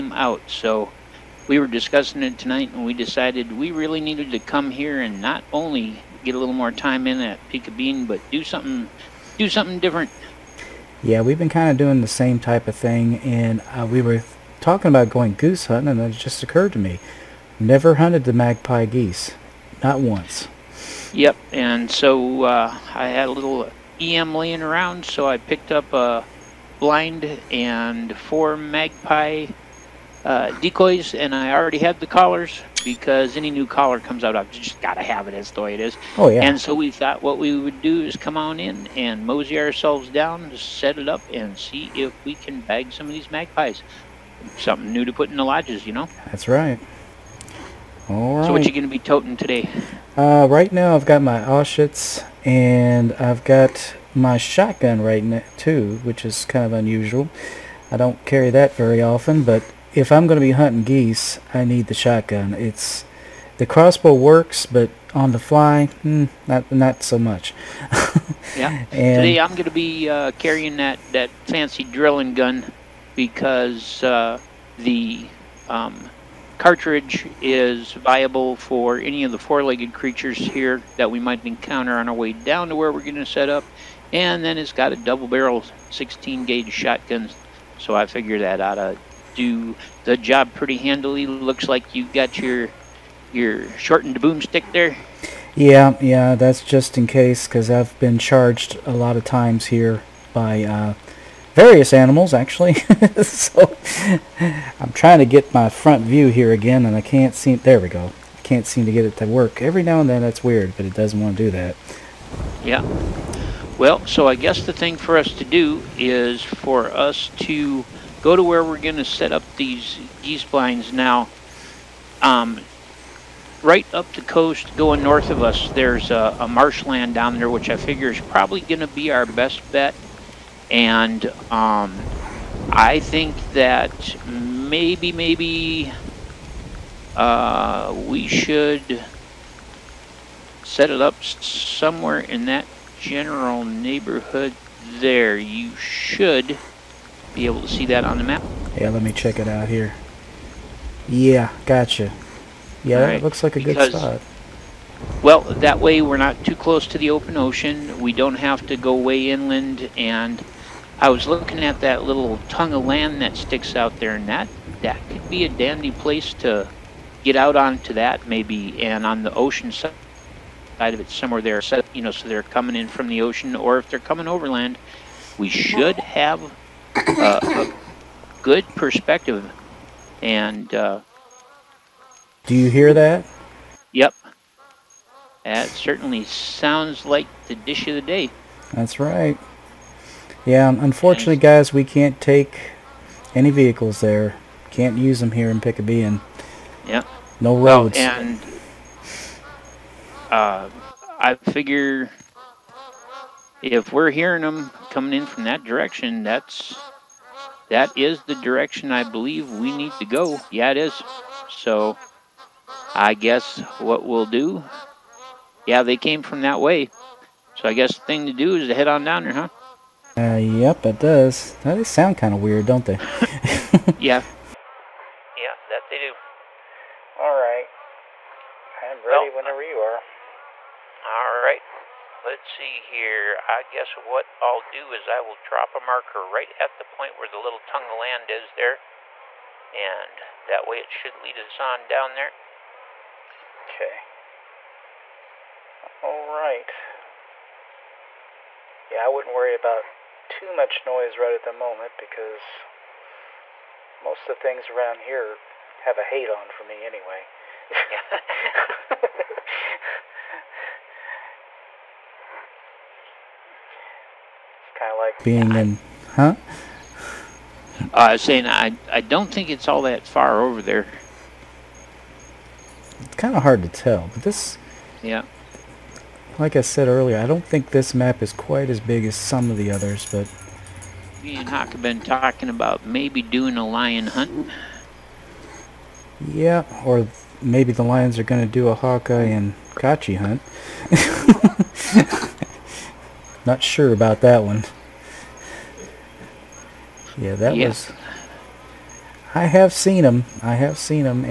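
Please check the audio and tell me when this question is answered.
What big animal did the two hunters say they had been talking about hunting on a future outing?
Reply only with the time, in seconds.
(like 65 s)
283 s.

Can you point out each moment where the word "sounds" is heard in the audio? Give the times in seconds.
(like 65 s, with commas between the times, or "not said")
186 s, 221 s.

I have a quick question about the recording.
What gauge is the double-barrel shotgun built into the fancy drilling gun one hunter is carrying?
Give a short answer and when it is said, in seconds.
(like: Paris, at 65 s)
16-gauge, at 85 s.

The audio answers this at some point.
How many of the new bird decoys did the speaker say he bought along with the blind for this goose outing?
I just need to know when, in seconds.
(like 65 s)
28 s.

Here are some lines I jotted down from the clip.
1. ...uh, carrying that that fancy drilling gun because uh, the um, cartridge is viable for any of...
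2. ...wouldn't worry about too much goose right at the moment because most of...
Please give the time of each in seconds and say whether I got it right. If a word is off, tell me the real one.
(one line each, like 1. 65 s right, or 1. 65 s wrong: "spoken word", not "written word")
1. 70 s right
2. 249 s wrong: "noise", not "goose".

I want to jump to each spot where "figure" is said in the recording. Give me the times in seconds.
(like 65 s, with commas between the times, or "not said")
88 s, 127 s, 201 s.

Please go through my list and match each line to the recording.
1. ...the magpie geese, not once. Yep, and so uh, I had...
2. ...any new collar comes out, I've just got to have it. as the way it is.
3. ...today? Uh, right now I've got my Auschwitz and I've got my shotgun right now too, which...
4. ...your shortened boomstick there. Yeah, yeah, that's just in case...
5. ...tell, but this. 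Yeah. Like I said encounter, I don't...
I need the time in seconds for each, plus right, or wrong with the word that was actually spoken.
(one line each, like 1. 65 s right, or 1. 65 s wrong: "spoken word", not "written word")
1. 18 s right
2. 33 s right
3. 49 s right
4. 93 s right
5. 273 s wrong: "earlier", not "encounter".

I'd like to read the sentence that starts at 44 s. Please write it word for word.
Something new to put in the lodges, you know?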